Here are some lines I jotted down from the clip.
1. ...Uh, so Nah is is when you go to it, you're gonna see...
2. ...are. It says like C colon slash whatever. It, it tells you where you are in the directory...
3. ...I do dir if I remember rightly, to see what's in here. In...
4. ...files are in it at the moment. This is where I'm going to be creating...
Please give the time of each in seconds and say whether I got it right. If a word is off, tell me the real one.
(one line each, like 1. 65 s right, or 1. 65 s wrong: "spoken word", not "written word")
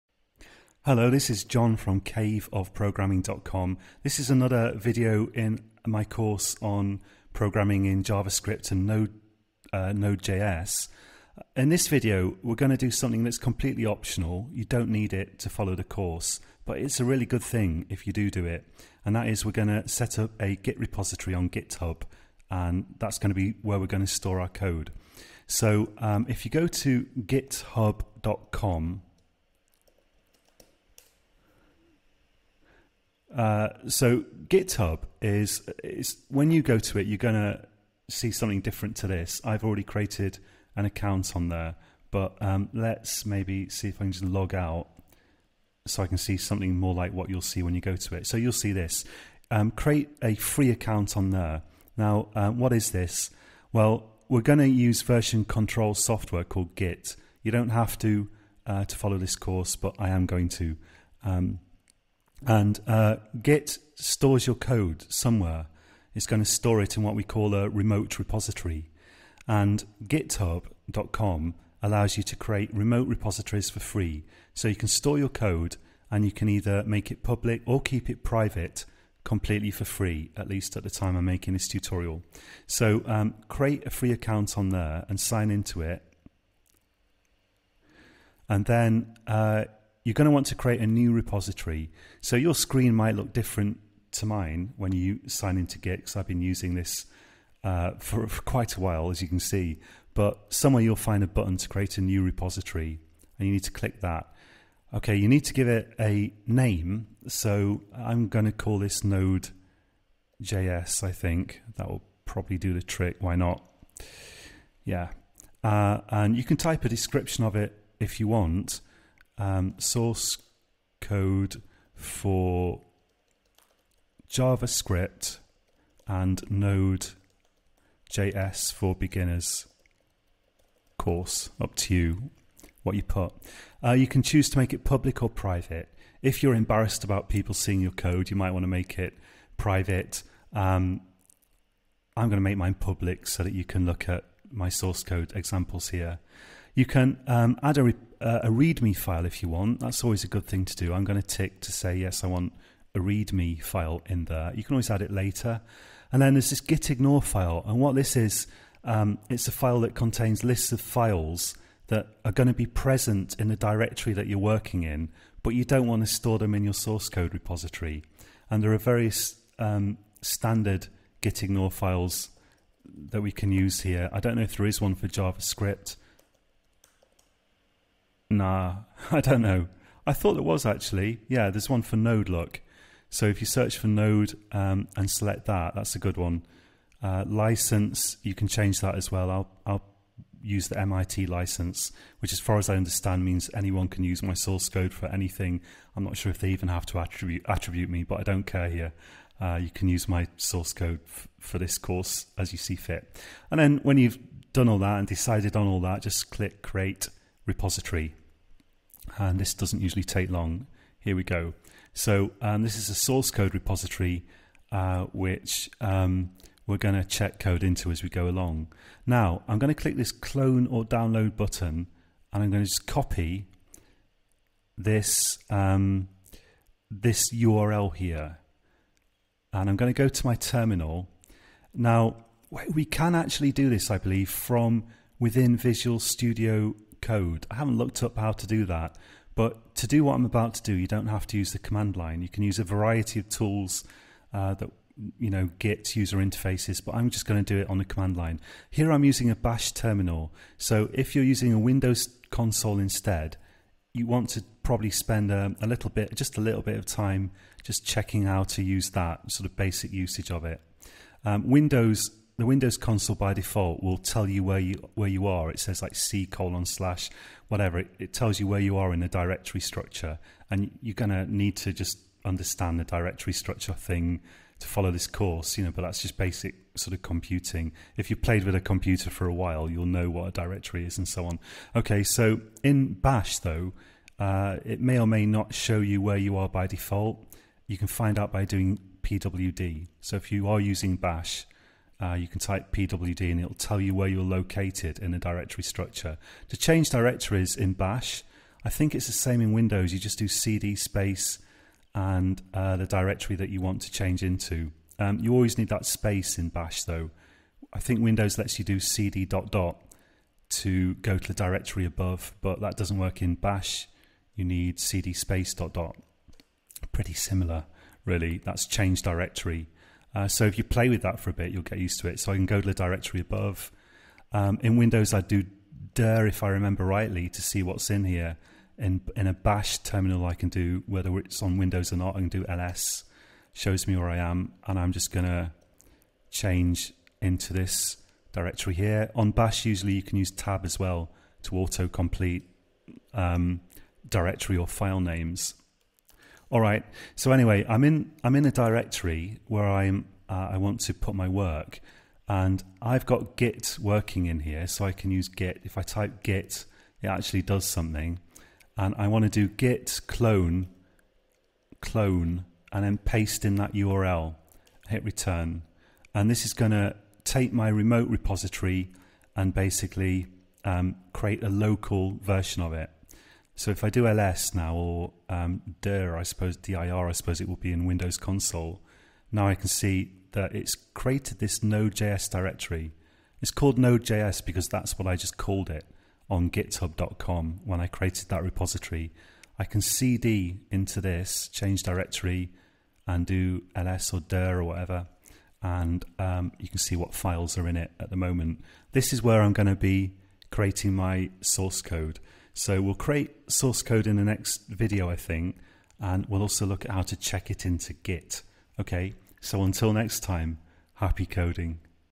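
1. 33 s wrong: "GitHub", not "Nah"
2. 265 s right
3. 325 s right
4. 397 s right.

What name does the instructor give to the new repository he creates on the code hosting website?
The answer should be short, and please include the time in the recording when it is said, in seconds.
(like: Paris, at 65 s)
node JS, at 109 s.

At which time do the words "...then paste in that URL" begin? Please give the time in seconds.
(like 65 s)
362 s.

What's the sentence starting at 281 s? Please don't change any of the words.
Okay, so in Bash though, uh, it may or may not show you where you are by default.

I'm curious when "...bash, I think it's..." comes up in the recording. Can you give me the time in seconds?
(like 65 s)
297 s.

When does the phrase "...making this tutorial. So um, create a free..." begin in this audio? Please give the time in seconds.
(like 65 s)
81 s.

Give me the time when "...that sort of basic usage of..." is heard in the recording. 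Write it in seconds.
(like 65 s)
258 s.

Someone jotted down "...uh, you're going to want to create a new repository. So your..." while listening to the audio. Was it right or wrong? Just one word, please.
right.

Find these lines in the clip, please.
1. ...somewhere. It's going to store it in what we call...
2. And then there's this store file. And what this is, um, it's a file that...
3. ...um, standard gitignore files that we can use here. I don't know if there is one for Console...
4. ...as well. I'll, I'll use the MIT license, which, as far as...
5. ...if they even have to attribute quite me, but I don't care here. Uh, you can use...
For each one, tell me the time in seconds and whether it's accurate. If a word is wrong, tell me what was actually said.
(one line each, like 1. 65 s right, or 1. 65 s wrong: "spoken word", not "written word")
1. 65 s right
2. 156 s wrong: "gitignore", not "store"
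3. 169 s wrong: "JavaScript", not "Console"
4. 188 s right
5. 196 s wrong: "attribute", not "quite".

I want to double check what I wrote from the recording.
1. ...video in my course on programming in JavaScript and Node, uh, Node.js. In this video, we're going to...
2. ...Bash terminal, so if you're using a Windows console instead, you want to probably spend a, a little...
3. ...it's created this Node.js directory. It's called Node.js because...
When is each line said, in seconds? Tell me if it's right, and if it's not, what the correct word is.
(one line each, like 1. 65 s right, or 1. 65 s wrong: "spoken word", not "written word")
1. 4 s right
2. 249 s right
3. 380 s right.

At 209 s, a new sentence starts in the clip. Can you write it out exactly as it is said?
And this doesn't usually take long.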